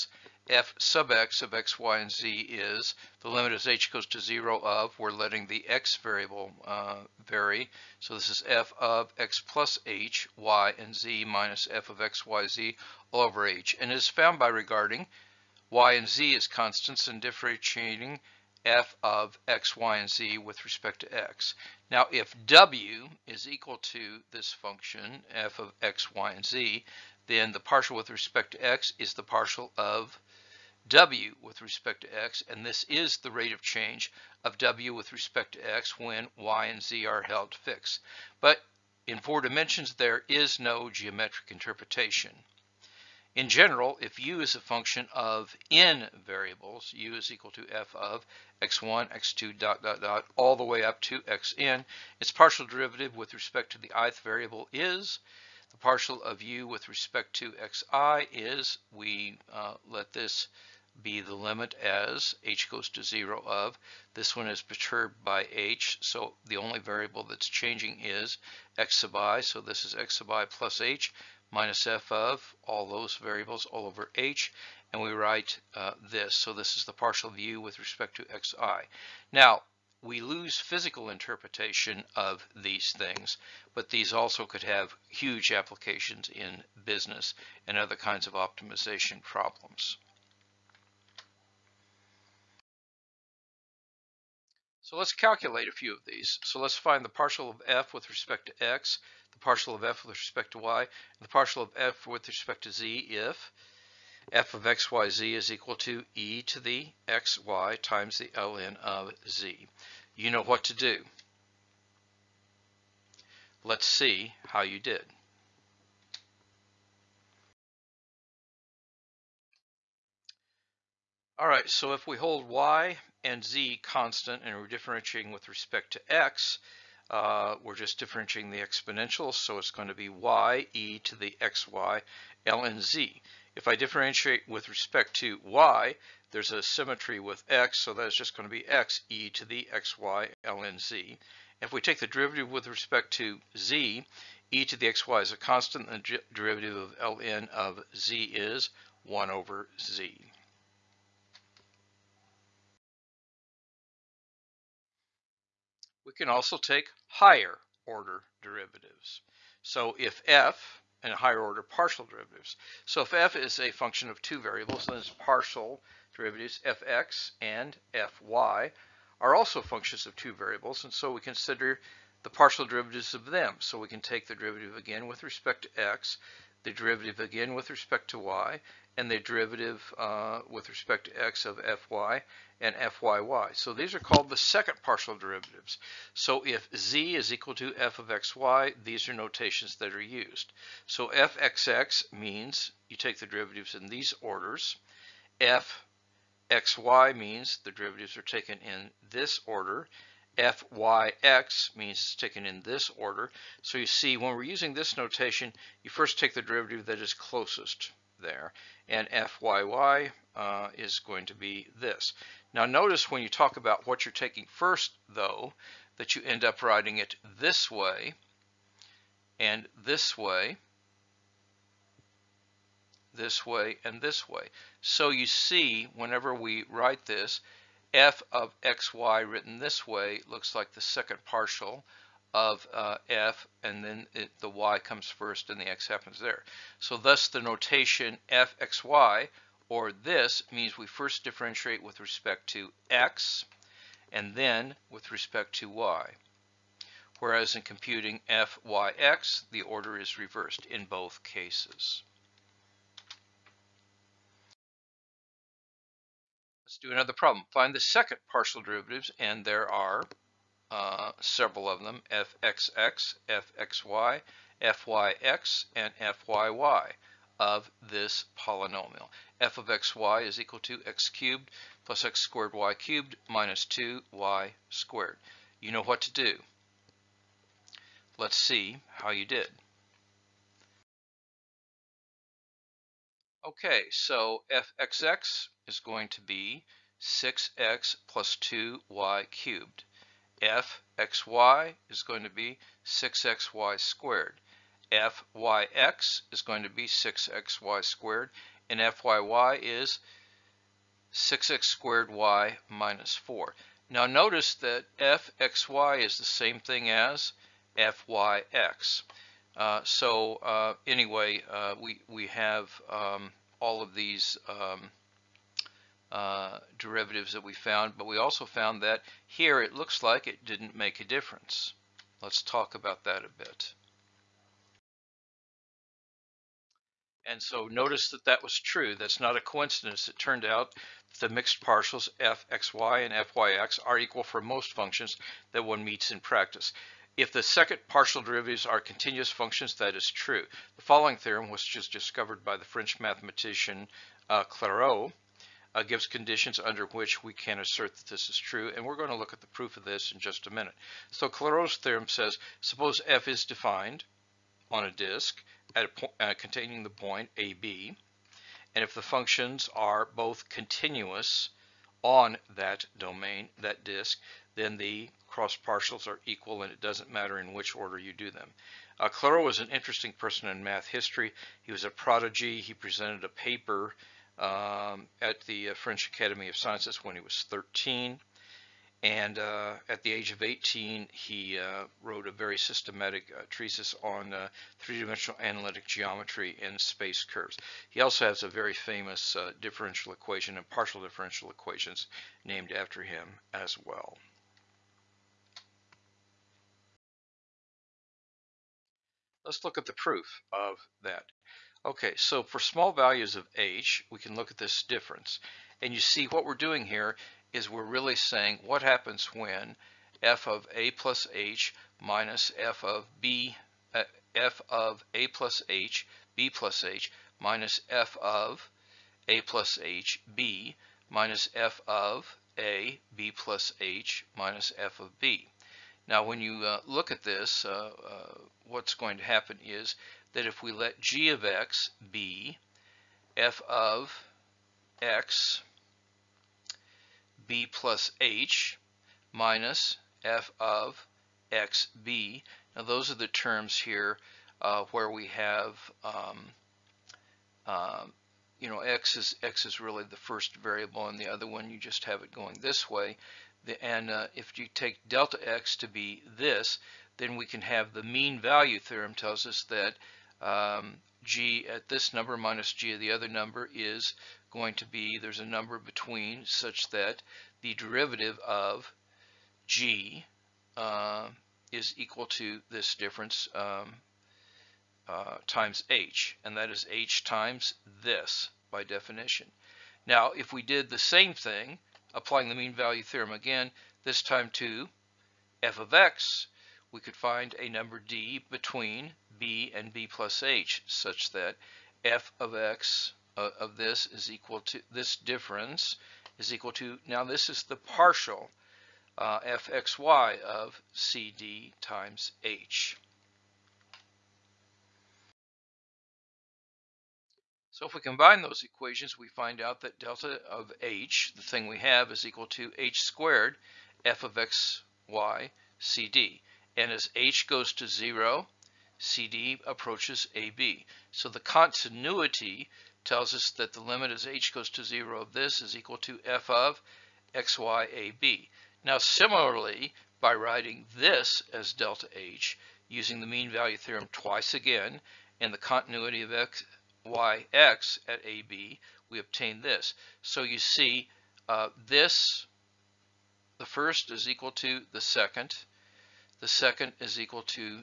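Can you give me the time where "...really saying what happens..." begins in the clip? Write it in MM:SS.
06:47.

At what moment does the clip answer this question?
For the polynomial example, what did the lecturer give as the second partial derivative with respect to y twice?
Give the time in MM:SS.
05:01.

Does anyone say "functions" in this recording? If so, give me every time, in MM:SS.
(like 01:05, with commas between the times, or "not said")
00:24, 00:44, 02:43, 02:49, 05:34, 05:39, 05:59.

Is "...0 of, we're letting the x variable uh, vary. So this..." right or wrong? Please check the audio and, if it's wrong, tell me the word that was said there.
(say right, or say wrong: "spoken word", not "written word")
right.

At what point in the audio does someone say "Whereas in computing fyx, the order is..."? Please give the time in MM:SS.
04:07.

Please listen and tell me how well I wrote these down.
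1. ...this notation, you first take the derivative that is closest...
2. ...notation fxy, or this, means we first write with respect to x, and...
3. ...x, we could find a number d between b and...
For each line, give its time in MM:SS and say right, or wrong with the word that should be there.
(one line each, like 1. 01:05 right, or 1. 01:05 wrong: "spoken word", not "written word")
1. 03:24 right
2. 03:57 wrong: "differentiate", not "write"
3. 08:05 right.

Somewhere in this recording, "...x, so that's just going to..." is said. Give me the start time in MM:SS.
02:17.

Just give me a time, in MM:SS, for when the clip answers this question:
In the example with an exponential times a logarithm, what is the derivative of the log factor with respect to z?
02:29.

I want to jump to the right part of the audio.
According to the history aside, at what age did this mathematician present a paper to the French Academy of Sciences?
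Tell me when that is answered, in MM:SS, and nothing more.
06:17.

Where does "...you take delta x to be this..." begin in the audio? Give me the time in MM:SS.
07:34.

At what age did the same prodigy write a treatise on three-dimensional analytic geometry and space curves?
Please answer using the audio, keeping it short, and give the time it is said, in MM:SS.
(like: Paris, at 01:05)
18, at 06:20.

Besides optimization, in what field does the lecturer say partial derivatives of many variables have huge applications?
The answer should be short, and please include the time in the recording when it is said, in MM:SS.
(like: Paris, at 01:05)
business, at 01:26.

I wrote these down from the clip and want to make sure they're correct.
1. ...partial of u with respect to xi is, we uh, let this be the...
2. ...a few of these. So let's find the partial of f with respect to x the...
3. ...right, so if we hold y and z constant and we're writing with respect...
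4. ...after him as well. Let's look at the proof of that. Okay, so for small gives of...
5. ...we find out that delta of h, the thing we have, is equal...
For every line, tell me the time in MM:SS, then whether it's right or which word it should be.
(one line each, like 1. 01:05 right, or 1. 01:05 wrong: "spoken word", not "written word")
1. 00:55 right
2. 01:35 right
3. 02:01 wrong: "differentiating", not "writing"
4. 06:32 wrong: "values", not "gives"
5. 08:29 right.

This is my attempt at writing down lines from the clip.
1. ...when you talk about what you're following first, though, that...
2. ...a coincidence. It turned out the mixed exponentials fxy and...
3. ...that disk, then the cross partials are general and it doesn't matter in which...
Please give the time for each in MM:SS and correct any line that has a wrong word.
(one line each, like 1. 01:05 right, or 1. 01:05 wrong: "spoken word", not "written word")
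1. 03:33 wrong: "taking", not "following"
2. 05:29 wrong: "partials", not "exponentials"
3. 06:03 wrong: "equal", not "general".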